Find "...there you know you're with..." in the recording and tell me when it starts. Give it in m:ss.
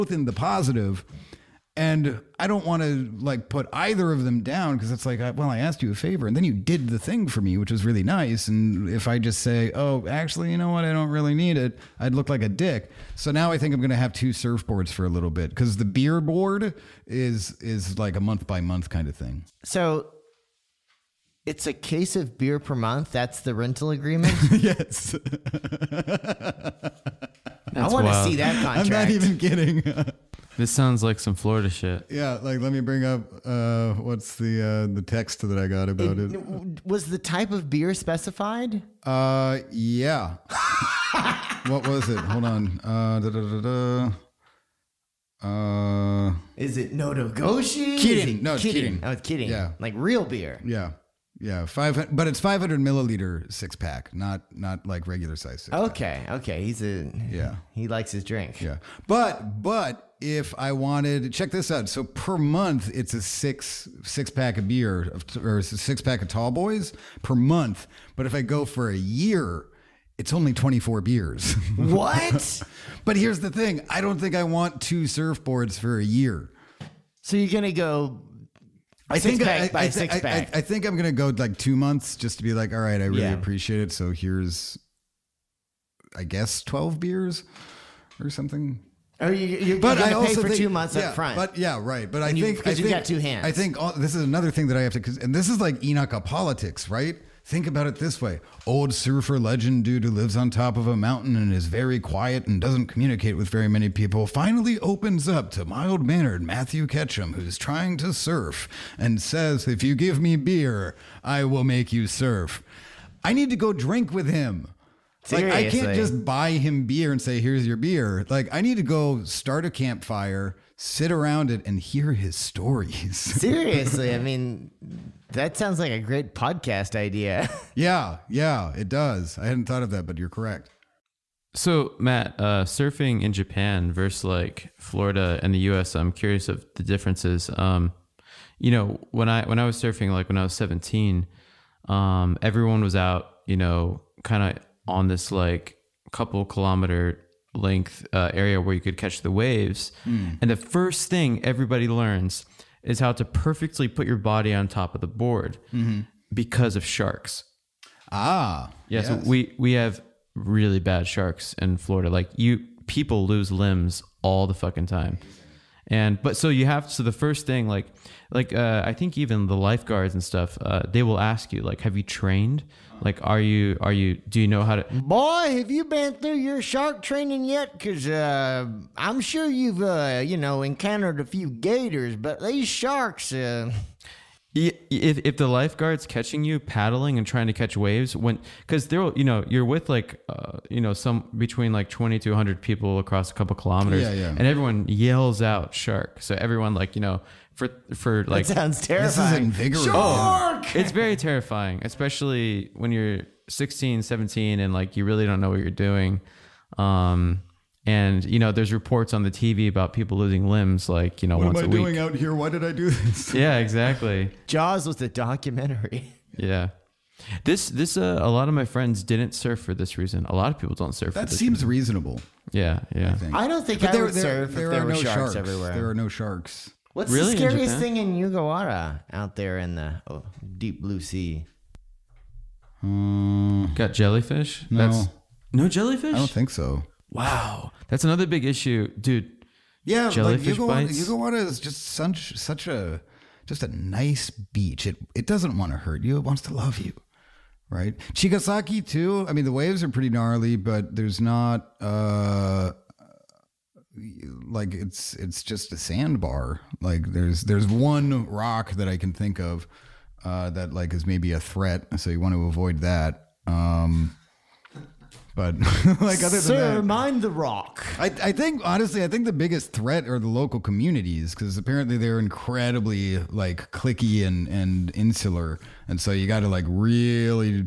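3:08.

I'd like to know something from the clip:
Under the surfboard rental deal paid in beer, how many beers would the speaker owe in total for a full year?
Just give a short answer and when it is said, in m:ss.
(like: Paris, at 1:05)
24, at 1:10.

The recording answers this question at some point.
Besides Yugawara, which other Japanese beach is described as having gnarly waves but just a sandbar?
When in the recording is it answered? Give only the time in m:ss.
4:08.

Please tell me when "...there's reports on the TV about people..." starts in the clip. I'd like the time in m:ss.
3:28.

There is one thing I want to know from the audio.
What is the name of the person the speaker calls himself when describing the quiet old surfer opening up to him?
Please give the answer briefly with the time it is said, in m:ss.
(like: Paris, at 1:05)
Matthew Ketchum, at 1:46.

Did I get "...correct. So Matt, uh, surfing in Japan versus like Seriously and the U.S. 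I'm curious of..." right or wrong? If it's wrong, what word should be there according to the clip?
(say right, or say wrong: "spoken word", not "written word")
wrong: "Florida", not "Seriously".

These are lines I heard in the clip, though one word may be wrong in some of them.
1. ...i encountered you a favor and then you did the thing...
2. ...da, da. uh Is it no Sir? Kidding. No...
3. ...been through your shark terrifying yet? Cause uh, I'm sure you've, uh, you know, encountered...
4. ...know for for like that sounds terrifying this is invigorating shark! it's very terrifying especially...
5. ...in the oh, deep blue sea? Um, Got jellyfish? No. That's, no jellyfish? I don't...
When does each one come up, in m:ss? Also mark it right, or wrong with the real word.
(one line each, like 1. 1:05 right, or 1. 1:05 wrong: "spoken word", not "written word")
1. 0:05 wrong: "asked", not "encountered"
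2. 0:43 wrong: "Nodogoshi", not "Sir"
3. 2:55 wrong: "training", not "terrifying"
4. 3:17 right
5. 3:49 right.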